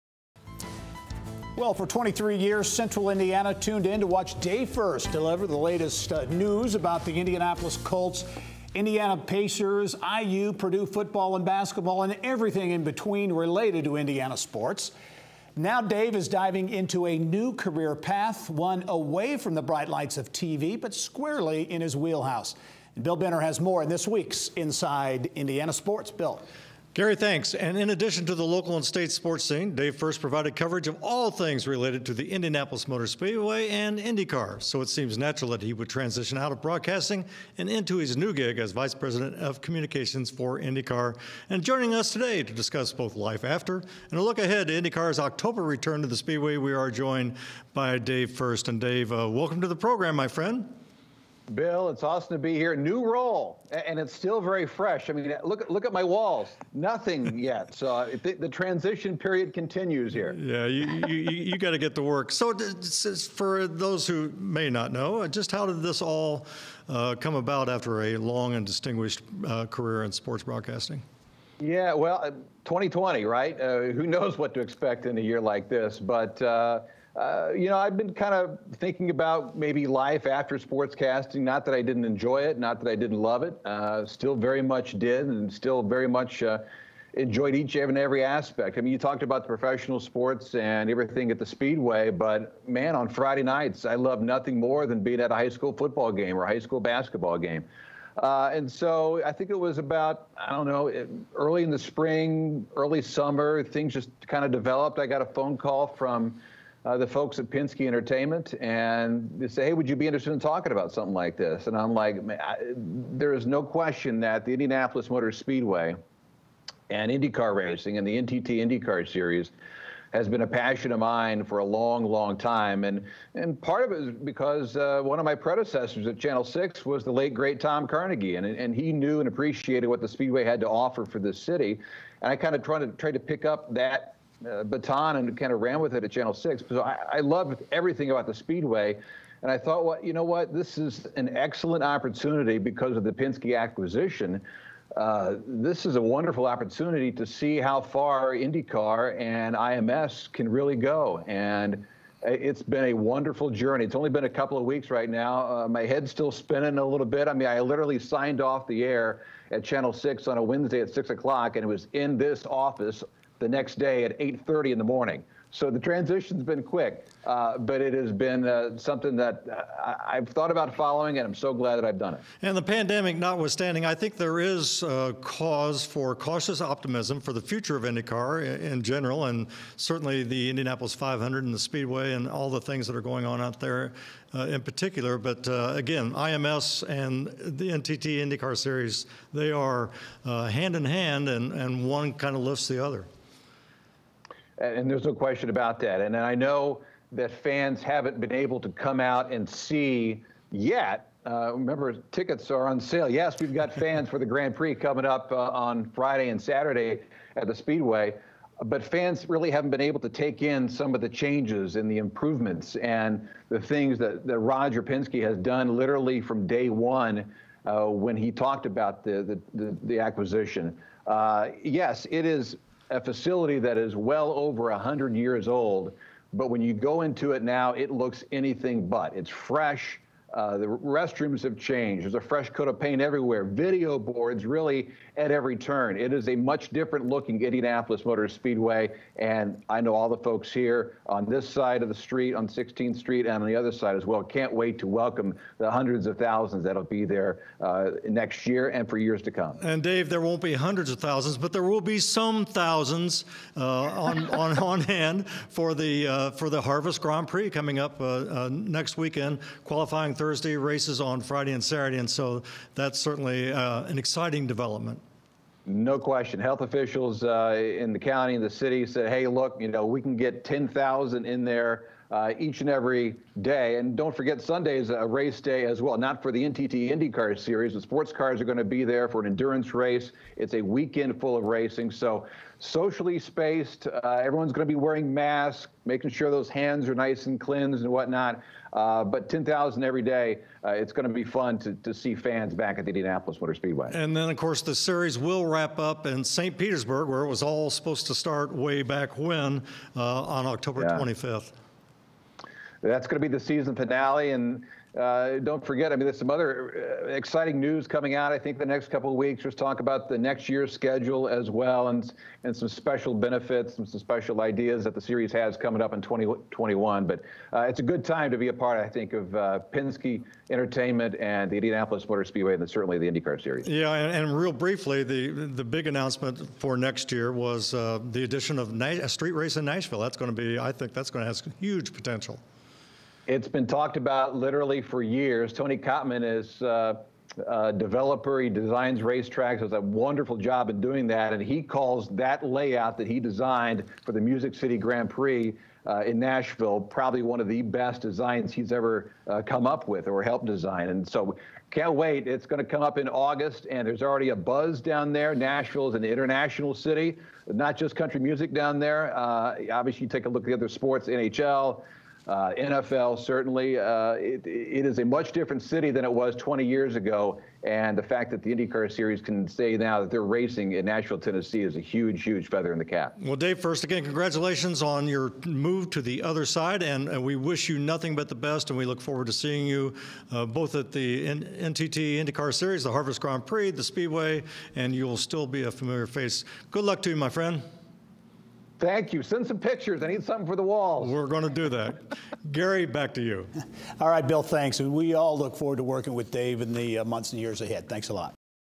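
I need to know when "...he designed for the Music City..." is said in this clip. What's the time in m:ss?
5:43.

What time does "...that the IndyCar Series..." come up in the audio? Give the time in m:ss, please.
6:08.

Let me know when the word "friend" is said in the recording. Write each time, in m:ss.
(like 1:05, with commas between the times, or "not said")
0:50, 6:27.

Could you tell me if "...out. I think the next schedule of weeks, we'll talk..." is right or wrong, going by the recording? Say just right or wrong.
wrong.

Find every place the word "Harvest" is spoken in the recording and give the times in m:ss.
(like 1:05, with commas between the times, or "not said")
4:16, 6:22.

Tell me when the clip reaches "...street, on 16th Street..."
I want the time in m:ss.
4:01.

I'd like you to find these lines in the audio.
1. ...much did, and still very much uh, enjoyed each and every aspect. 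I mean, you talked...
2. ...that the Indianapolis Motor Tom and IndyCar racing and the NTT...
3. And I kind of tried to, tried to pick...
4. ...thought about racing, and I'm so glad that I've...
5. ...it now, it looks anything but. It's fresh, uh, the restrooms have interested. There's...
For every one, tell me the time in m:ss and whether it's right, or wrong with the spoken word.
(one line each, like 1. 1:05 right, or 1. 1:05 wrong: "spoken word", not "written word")
1. 1:24 right
2. 1:54 wrong: "Speedway", not "Tom"
3. 2:12 right
4. 2:50 wrong: "following", not "racing"
5. 3:47 wrong: "changed", not "interested".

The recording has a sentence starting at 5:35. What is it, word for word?
Tony Cotman is uh, a uh, developer.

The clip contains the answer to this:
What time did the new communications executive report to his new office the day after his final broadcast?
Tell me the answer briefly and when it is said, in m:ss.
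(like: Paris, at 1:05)
8:30 in the morning, at 2:44.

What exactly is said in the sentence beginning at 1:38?
Uh, and so I think it was about, I don't know, early in the spring, early summer, things just kind of developed.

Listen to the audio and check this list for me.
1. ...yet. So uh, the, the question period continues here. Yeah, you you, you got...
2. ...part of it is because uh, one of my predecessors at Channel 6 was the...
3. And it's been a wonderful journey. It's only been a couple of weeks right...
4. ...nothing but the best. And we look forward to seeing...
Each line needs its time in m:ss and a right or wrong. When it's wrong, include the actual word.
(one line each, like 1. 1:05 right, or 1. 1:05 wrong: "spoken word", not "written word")
1. 0:57 wrong: "transition", not "question"
2. 2:03 right
3. 2:31 right
4. 6:17 right.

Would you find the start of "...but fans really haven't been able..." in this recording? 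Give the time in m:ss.
3:28.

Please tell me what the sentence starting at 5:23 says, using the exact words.
Yeah, and, and real briefly, the the big announcement for next year was uh, the addition of a street race in Nashville.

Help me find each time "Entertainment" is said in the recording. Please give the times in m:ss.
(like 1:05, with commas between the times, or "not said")
1:47, 5:20.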